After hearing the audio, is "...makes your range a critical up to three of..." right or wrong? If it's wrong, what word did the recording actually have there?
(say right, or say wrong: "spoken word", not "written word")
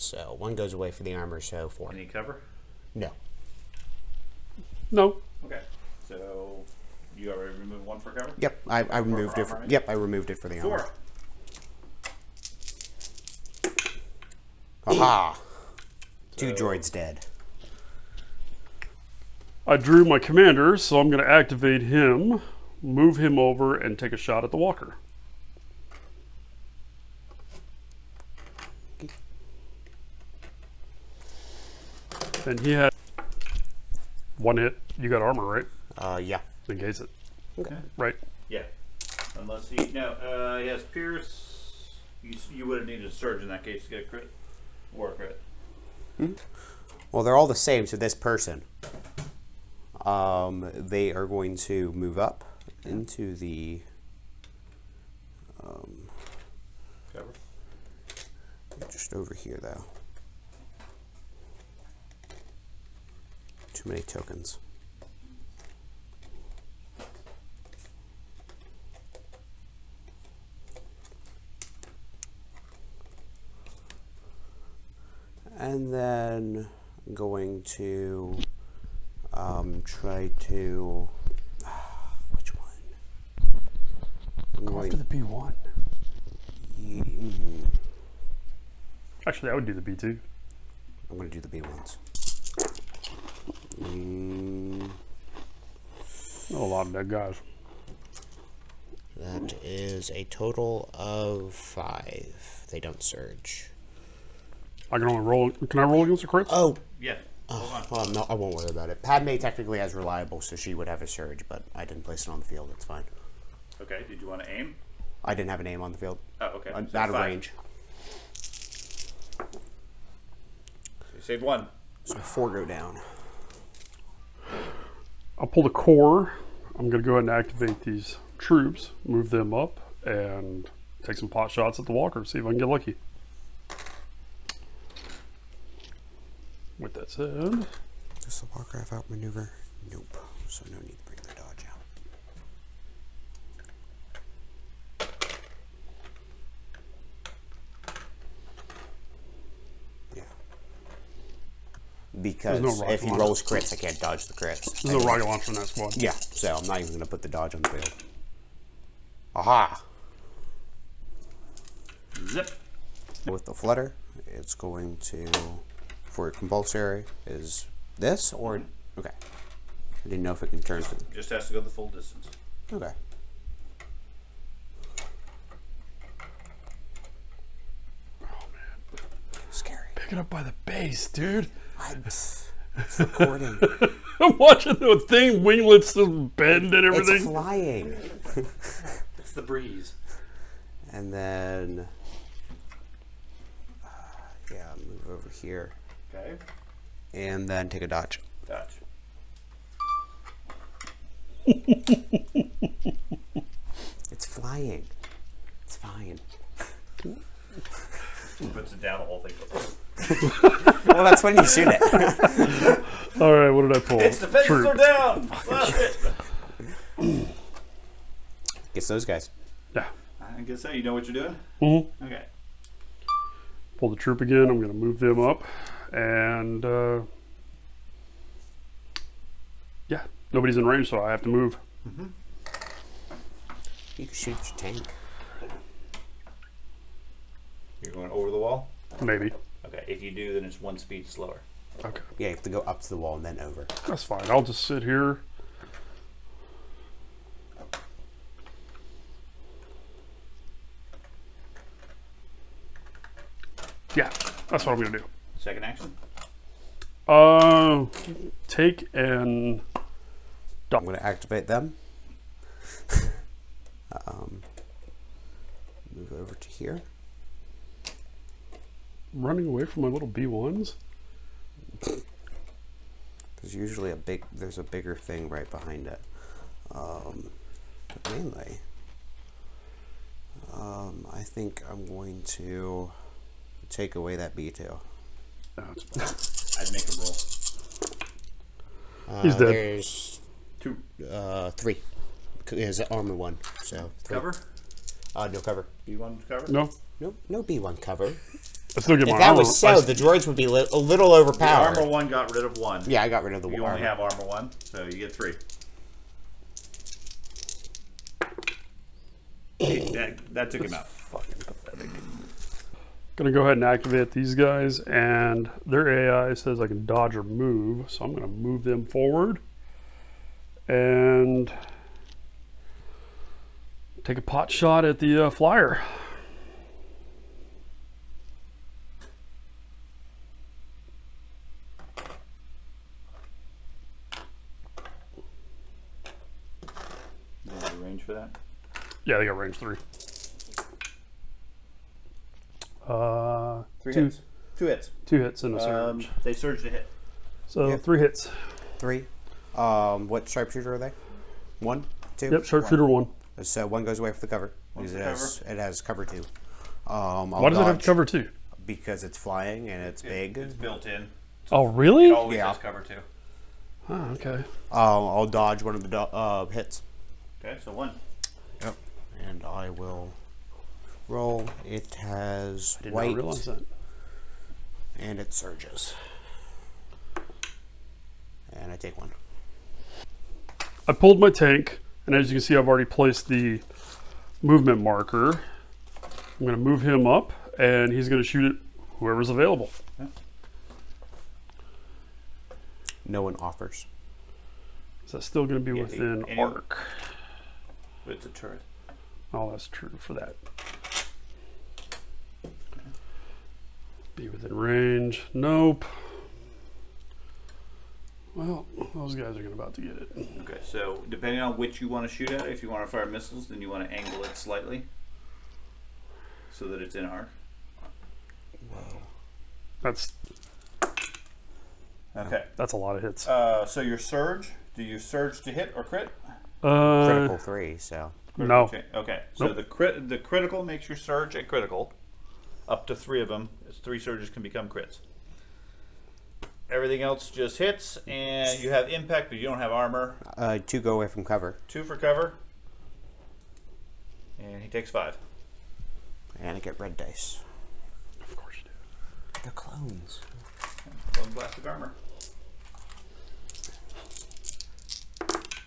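wrong: "surge", not "range".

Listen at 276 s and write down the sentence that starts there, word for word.
Um, mainly, um, I think I'm going to take away that B2.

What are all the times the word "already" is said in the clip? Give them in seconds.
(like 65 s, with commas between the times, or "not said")
7 s, 382 s.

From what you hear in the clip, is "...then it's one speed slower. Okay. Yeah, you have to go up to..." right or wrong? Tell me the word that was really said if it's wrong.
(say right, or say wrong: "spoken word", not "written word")
right.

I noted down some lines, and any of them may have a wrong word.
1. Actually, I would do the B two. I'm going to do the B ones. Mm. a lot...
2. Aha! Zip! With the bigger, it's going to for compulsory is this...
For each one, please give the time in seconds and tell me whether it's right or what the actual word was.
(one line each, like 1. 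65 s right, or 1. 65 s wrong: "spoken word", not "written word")
1. 89 s right
2. 159 s wrong: "flutter", not "bigger".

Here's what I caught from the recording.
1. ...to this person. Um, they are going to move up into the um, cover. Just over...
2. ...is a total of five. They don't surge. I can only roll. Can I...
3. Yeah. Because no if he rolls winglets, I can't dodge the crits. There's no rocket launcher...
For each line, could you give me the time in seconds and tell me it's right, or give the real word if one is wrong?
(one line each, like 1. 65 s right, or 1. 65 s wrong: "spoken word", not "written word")
1. 47 s right
2. 99 s right
3. 150 s wrong: "crits", not "winglets".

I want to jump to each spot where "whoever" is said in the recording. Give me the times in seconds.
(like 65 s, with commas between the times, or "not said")
388 s.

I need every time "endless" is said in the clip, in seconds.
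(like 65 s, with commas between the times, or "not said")
not said.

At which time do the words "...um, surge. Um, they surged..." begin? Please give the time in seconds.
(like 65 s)
345 s.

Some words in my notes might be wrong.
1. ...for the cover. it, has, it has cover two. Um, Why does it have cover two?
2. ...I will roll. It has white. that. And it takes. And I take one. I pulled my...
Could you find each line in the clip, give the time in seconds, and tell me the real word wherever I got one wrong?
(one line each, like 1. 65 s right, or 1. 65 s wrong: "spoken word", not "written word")
1. 354 s right
2. 369 s wrong: "surges", not "takes".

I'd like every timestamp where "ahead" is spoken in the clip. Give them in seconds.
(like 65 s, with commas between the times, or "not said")
127 s, 313 s.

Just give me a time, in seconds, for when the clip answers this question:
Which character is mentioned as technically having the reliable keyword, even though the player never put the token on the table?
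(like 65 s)
109 s.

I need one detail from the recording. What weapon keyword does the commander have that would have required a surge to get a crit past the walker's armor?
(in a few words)
Pierce.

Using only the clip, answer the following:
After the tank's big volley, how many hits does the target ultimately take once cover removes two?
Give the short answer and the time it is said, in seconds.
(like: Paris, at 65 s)
5, at 444 s.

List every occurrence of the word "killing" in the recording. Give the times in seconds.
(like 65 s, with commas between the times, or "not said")
not said.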